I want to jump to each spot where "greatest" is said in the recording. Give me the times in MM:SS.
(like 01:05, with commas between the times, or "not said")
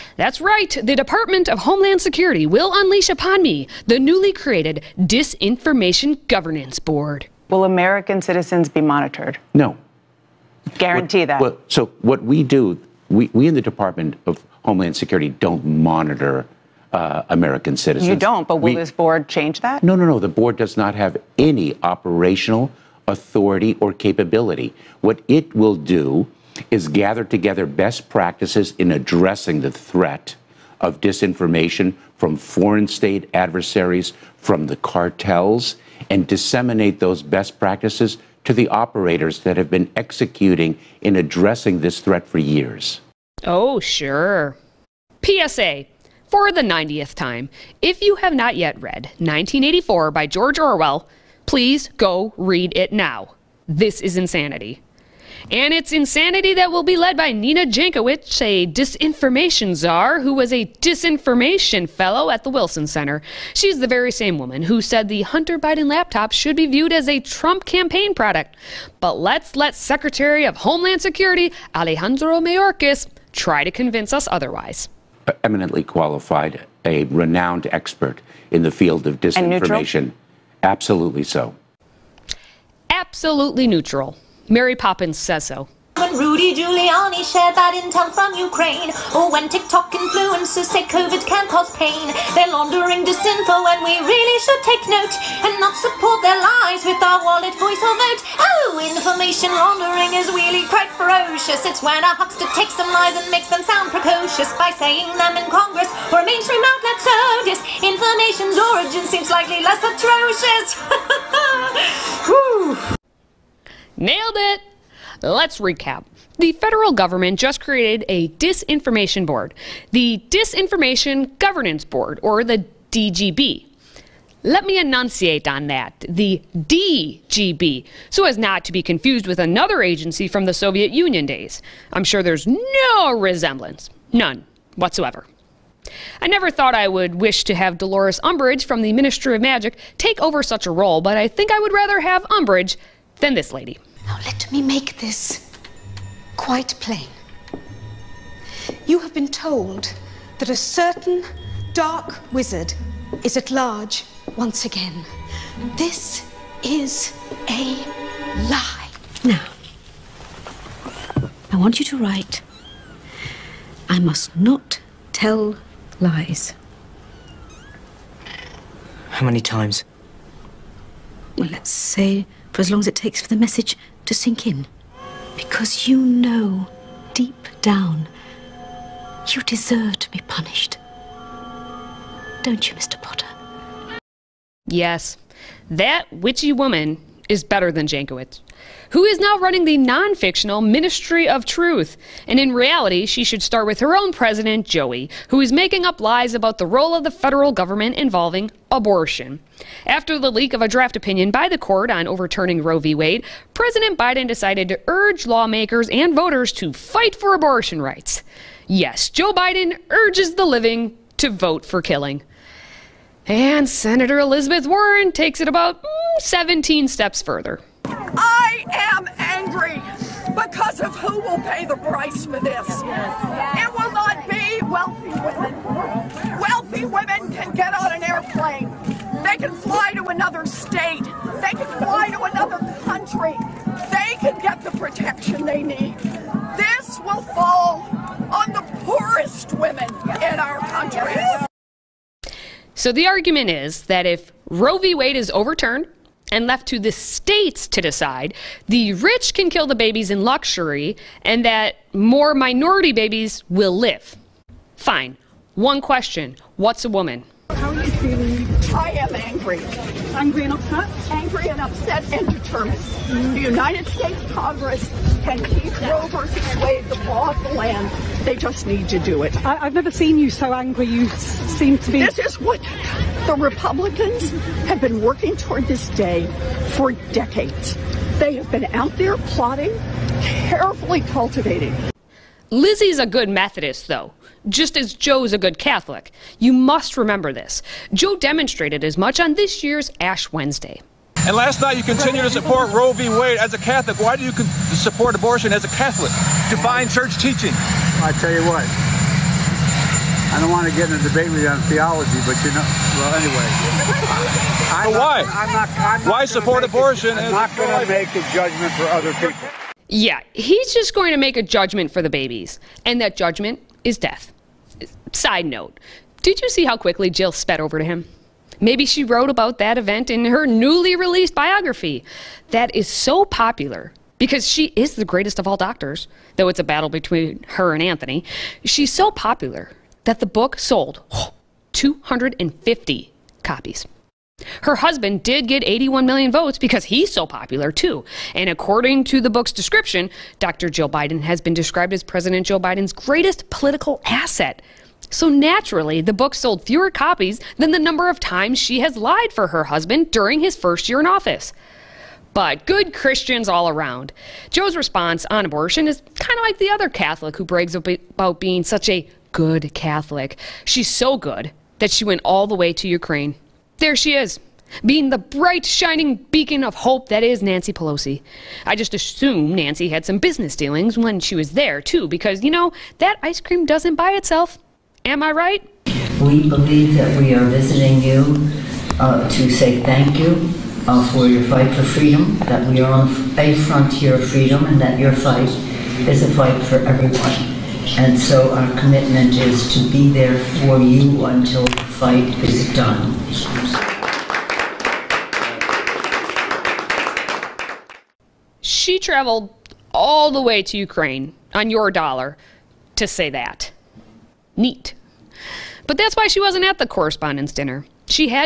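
05:25, 05:42.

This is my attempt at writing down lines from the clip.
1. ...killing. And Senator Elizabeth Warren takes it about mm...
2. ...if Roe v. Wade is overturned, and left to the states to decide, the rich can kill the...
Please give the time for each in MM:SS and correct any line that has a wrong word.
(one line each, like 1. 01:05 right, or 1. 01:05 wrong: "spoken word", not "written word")
1. 03:31 right
2. 04:04 right.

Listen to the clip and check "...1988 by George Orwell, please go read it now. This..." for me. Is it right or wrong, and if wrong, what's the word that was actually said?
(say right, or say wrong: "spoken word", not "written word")
wrong: "1984", not "1988".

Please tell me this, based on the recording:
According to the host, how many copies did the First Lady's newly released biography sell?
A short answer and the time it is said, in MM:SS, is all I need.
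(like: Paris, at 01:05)
250, at 05:31.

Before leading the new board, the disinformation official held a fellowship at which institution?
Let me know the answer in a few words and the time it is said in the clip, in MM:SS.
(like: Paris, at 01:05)
Wilson Center, at 01:02.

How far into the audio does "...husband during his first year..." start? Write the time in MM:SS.
05:49.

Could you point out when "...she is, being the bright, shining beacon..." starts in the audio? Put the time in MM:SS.
06:03.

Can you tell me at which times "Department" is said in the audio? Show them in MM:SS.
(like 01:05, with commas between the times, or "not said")
00:00, 00:13.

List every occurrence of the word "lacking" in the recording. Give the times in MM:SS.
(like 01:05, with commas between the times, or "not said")
not said.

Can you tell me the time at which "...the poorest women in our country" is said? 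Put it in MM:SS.
03:58.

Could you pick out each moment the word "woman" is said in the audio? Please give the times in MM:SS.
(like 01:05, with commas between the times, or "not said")
01:04, 03:06, 04:16.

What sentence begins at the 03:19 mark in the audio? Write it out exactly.
After the leak of a draft opinion by the court on overturning Roe v.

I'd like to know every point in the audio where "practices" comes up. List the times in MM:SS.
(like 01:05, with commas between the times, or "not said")
00:28, 00:37.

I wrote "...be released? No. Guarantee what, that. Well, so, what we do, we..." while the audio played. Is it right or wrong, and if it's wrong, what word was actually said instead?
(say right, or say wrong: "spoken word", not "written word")
wrong: "monitored", not "released".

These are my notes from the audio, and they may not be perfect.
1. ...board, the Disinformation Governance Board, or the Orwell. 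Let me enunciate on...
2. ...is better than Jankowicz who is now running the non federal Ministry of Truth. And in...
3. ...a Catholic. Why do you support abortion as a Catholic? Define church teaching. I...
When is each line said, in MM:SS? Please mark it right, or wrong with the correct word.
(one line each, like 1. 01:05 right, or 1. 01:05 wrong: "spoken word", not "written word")
1. 01:59 wrong: "DGB", not "Orwell"
2. 03:07 wrong: "fictional", not "federal"
3. 04:53 right.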